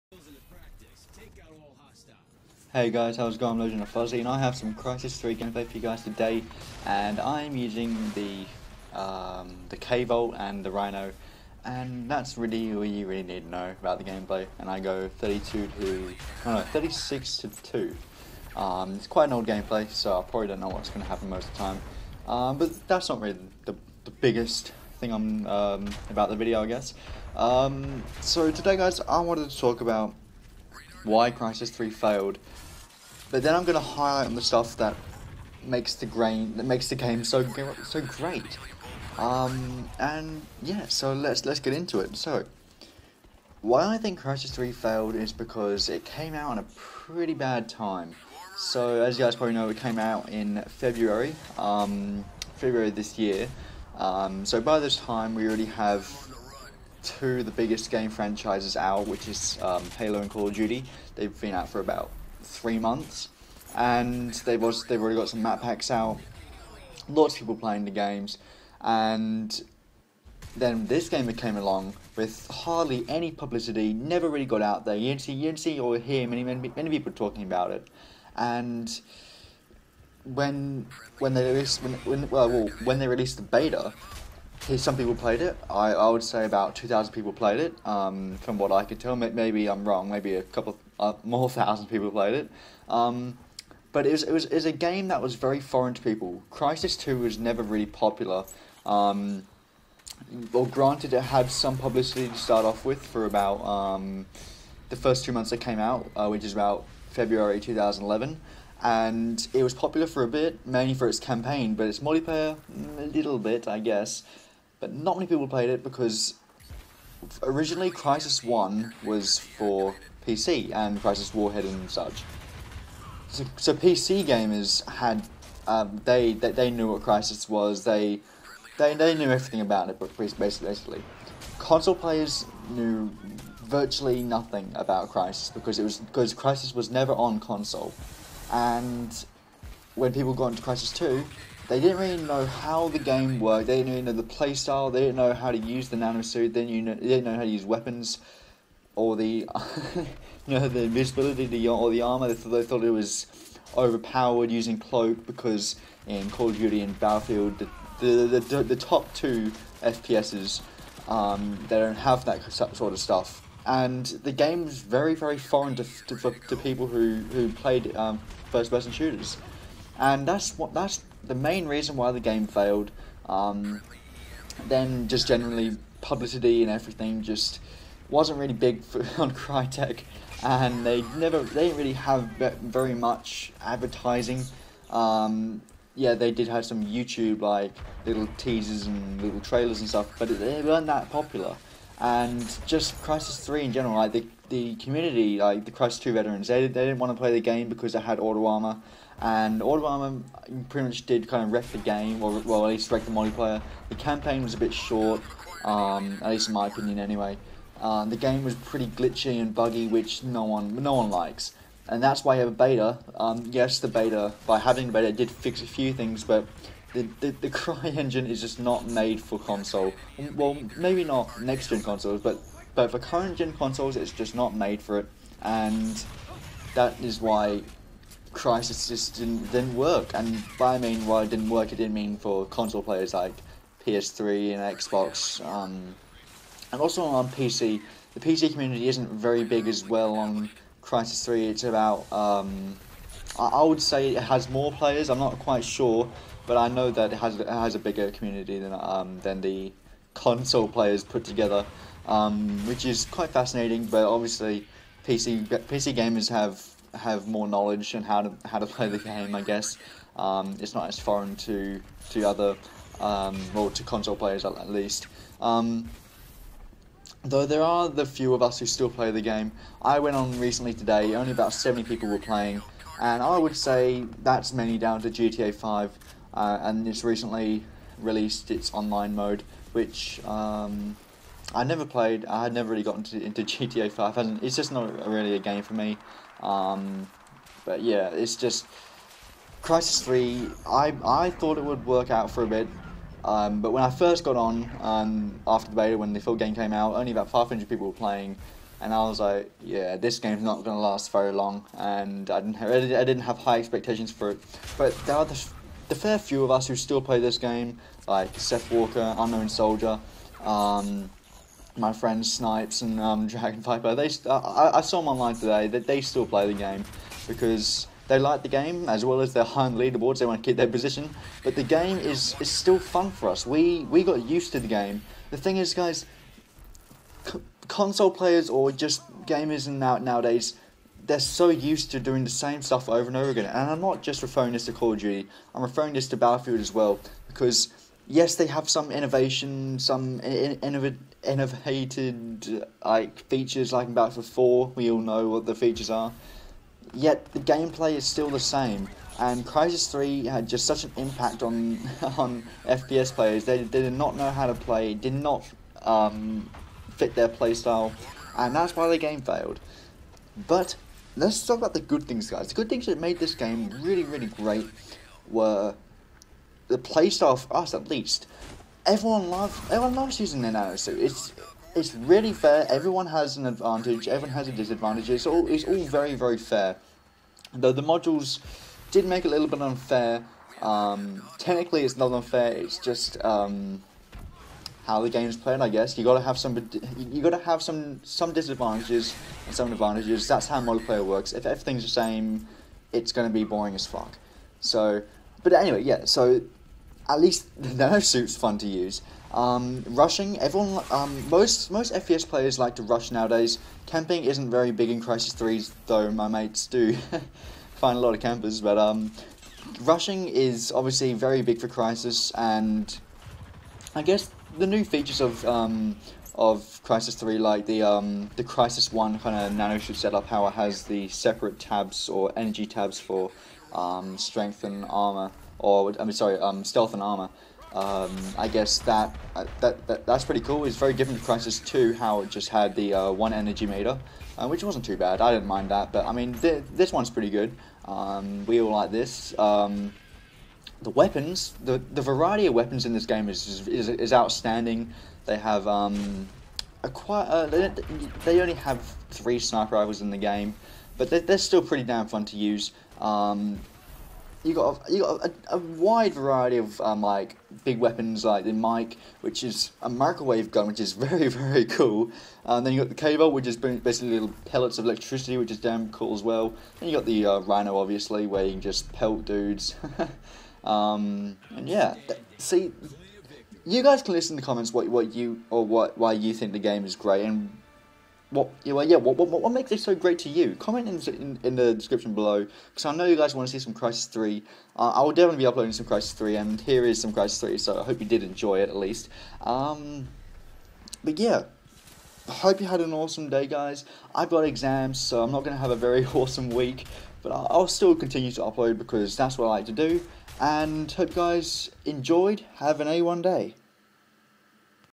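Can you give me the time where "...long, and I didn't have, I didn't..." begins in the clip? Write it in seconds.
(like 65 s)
301 s.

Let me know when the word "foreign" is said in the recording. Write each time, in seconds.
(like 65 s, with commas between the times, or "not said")
95 s, 165 s, 260 s.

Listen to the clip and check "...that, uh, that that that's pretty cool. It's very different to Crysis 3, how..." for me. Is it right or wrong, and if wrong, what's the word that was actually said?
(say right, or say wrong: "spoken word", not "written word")
wrong: "2", not "3".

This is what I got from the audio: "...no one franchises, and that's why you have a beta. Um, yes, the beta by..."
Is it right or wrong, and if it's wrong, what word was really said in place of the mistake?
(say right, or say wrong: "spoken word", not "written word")
wrong: "likes", not "franchises".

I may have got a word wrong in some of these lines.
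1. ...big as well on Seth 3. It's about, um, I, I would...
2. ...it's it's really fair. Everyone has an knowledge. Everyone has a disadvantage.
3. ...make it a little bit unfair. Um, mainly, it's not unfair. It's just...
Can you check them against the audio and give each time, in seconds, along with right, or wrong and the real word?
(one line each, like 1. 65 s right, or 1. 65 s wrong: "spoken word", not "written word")
1. 239 s wrong: "Crysis", not "Seth"
2. 370 s wrong: "advantage", not "knowledge"
3. 379 s wrong: "technically", not "mainly".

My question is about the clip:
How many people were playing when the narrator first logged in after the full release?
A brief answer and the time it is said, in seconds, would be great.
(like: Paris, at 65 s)
500, at 297 s.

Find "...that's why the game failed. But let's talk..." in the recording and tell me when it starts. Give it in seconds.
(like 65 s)
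358 s.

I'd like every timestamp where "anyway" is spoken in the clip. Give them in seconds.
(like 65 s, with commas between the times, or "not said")
206 s, 395 s.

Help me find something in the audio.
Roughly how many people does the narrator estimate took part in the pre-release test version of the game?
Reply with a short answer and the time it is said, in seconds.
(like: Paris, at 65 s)
2,000, at 86 s.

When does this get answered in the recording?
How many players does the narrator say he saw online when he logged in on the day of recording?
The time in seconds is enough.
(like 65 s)
271 s.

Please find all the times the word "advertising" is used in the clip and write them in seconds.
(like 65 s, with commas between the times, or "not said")
183 s.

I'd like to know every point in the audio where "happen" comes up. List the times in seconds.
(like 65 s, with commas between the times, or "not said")
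21 s.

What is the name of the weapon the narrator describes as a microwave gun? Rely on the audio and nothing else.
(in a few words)
the Mic.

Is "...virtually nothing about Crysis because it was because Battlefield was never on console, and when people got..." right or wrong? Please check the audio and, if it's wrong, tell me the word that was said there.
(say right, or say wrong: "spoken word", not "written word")
wrong: "Crysis", not "Battlefield".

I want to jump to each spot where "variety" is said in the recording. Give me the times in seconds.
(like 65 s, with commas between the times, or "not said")
442 s, 456 s.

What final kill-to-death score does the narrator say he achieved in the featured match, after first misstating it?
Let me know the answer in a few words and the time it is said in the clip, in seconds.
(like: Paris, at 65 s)
36 to 2, at 16 s.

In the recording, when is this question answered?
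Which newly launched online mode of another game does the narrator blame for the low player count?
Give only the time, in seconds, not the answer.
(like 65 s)
275 s.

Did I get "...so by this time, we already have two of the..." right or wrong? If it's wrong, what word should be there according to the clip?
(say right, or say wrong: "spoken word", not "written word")
right.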